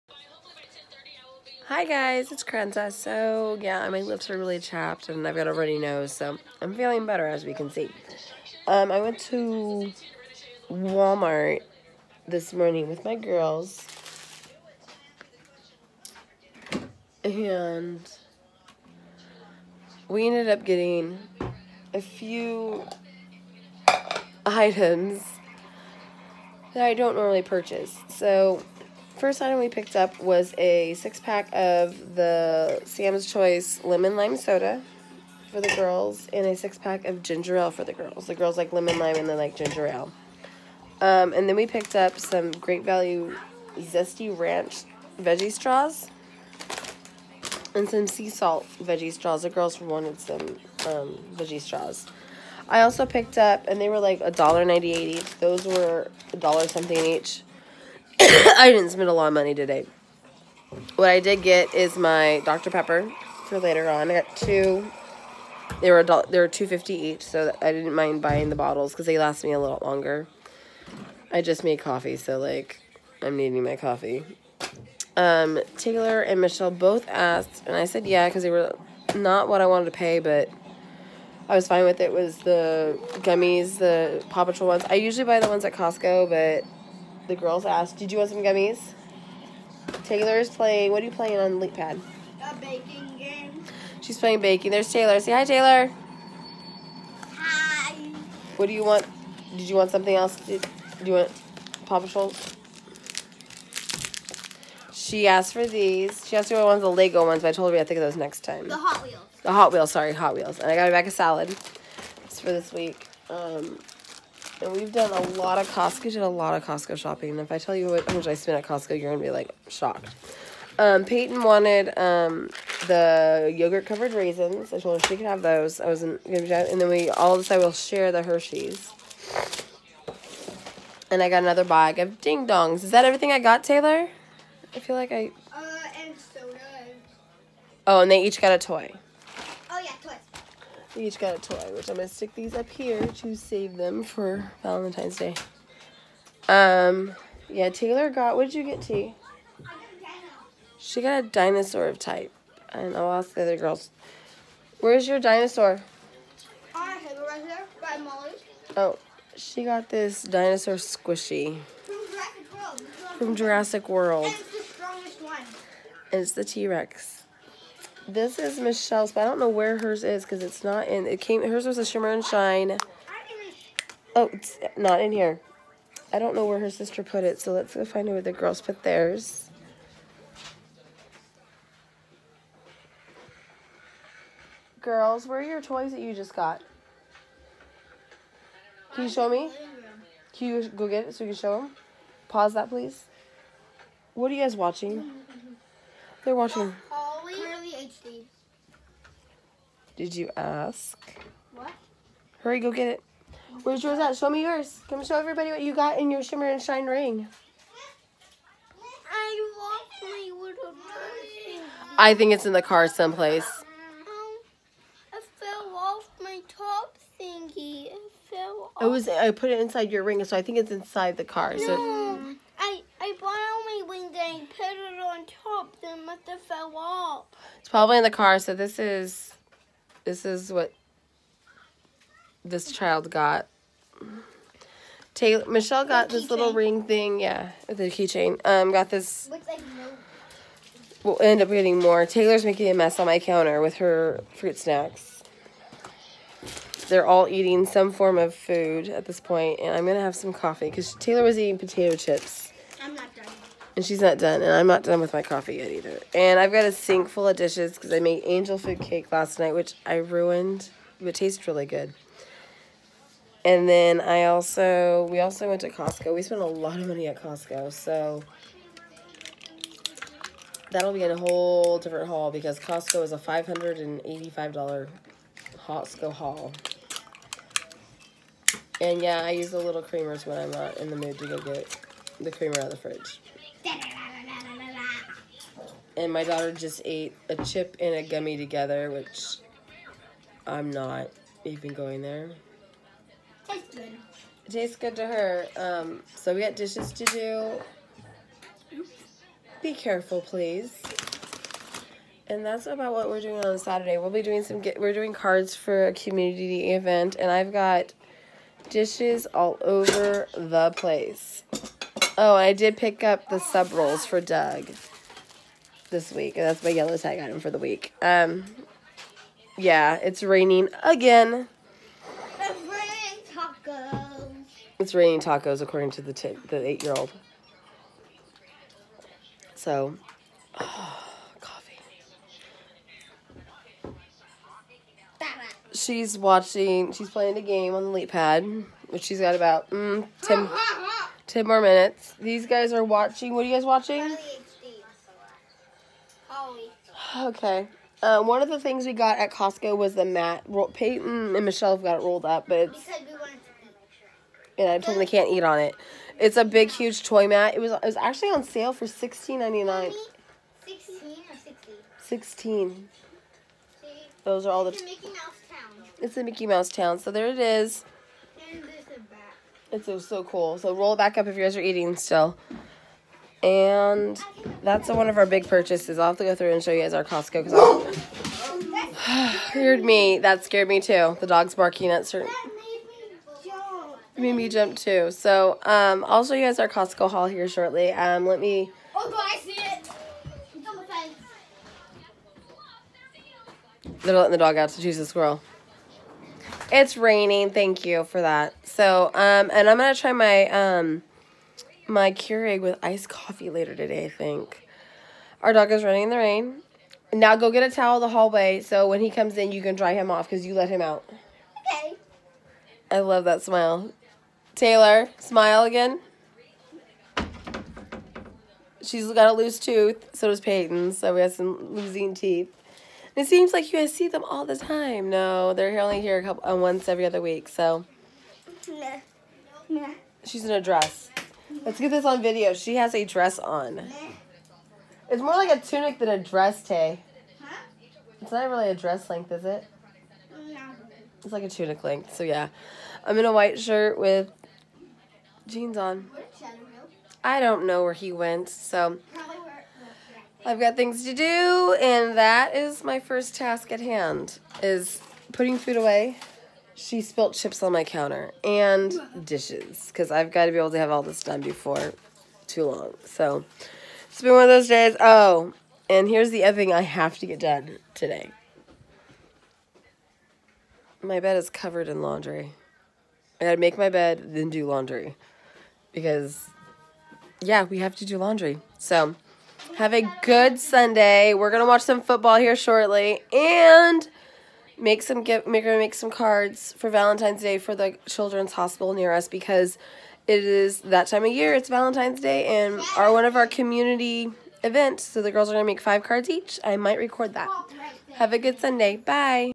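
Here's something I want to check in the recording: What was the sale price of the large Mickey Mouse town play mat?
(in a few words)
16.99.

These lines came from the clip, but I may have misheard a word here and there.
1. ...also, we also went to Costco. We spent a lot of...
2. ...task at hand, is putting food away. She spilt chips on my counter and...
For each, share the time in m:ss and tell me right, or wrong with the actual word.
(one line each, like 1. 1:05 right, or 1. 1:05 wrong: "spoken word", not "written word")
1. 4:24 right
2. 7:33 right.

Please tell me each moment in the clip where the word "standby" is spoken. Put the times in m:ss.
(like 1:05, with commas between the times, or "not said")
not said.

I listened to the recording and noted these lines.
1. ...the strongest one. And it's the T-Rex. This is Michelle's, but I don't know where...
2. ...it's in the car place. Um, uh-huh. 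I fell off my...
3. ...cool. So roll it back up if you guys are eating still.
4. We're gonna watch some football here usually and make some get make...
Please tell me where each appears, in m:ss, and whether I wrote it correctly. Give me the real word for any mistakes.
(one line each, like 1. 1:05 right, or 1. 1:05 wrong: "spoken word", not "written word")
1. 2:44 right
2. 3:32 wrong: "someplace", not "place"
3. 6:10 right
4. 8:01 wrong: "shortly", not "usually".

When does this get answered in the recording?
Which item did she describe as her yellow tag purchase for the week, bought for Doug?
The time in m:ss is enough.
5:13.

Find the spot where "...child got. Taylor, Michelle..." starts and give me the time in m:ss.
3:52.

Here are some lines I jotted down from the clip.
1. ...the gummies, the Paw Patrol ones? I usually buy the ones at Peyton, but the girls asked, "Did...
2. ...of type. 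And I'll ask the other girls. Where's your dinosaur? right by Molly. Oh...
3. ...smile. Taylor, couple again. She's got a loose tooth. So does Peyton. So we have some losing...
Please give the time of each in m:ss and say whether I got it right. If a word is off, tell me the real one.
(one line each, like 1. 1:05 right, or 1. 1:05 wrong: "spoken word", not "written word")
1. 1:22 wrong: "Costco", not "Peyton"
2. 2:31 right
3. 6:53 wrong: "smile", not "couple".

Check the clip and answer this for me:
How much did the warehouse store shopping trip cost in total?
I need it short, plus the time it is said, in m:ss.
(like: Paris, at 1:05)
$585, at 4:33.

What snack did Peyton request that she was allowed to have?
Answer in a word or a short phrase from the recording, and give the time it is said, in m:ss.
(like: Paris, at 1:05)
yogurt covered raisins, at 2:03.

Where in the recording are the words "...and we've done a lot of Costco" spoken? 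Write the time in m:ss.
1:54.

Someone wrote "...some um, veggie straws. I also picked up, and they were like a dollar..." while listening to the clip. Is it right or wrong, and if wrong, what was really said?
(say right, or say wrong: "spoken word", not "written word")
right.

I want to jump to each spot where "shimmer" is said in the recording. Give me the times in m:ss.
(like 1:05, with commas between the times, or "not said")
2:51, 3:26.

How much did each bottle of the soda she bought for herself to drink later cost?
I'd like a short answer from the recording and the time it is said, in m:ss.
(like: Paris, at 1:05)
2.50, at 1:06.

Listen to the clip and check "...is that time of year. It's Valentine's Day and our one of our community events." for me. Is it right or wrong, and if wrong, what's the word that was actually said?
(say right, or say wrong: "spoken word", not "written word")
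right.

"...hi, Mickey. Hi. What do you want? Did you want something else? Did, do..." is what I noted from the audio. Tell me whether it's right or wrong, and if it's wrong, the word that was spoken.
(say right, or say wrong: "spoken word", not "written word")
wrong: "Taylor", not "Mickey".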